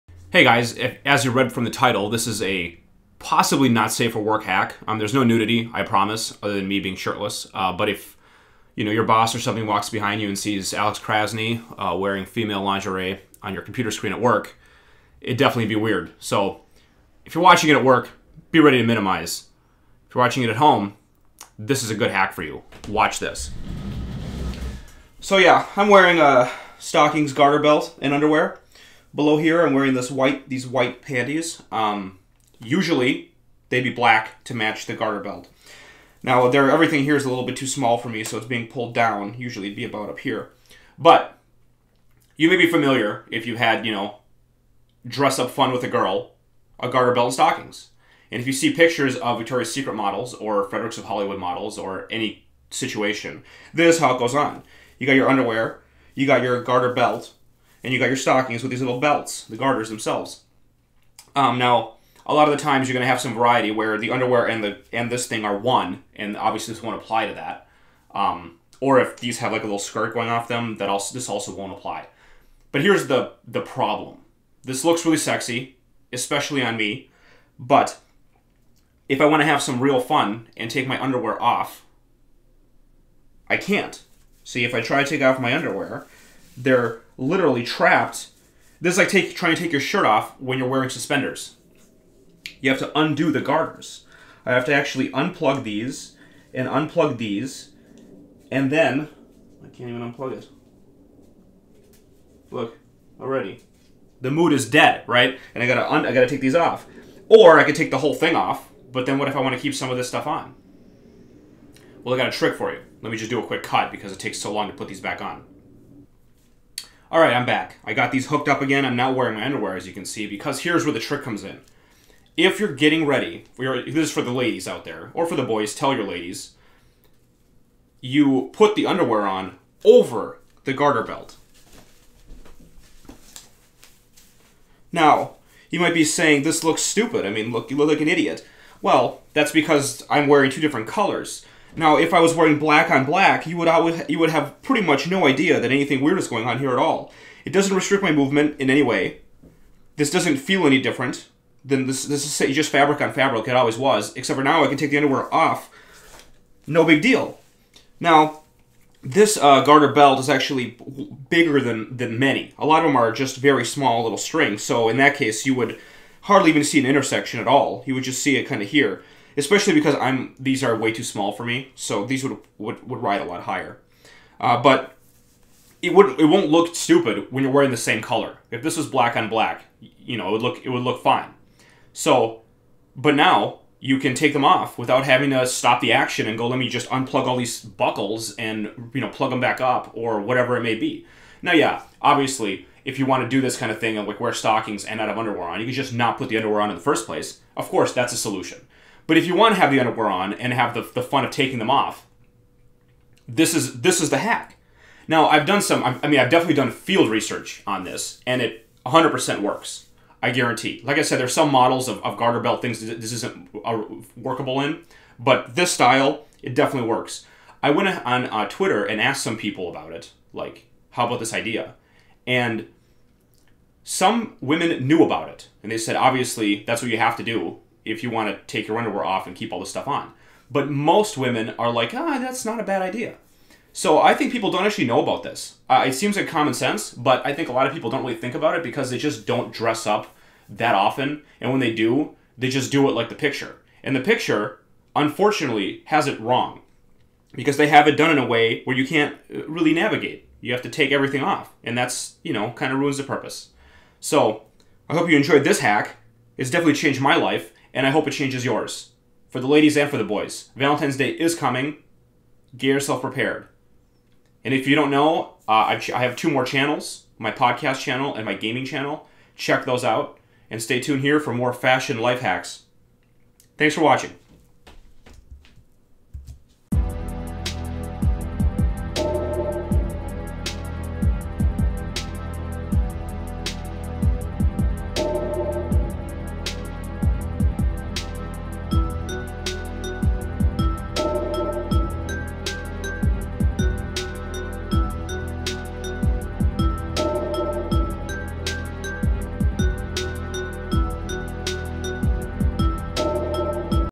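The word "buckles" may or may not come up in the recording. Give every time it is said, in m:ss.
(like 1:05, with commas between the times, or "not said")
3:07.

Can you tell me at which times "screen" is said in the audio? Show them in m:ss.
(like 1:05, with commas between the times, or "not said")
0:13.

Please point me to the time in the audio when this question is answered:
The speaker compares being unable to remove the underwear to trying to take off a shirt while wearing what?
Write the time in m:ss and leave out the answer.
1:30.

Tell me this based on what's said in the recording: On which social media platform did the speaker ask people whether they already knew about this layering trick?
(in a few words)
Twitter.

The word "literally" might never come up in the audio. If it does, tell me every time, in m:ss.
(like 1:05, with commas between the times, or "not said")
1:27.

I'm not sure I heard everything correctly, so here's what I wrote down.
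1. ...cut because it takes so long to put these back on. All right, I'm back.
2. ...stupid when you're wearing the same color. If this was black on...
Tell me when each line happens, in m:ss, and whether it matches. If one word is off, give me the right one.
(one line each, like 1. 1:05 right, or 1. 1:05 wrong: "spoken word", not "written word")
1. 1:53 right
2. 2:56 right.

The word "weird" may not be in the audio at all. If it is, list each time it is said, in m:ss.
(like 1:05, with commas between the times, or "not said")
0:15, 2:26.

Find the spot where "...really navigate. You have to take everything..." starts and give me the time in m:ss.
4:09.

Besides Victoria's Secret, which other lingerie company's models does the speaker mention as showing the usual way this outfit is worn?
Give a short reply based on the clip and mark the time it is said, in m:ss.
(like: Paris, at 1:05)
Fredericks of Hollywood, at 0:50.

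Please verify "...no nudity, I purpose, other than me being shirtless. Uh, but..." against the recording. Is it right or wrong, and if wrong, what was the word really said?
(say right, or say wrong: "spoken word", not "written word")
wrong: "promise", not "purpose".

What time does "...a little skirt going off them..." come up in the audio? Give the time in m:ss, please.
1:09.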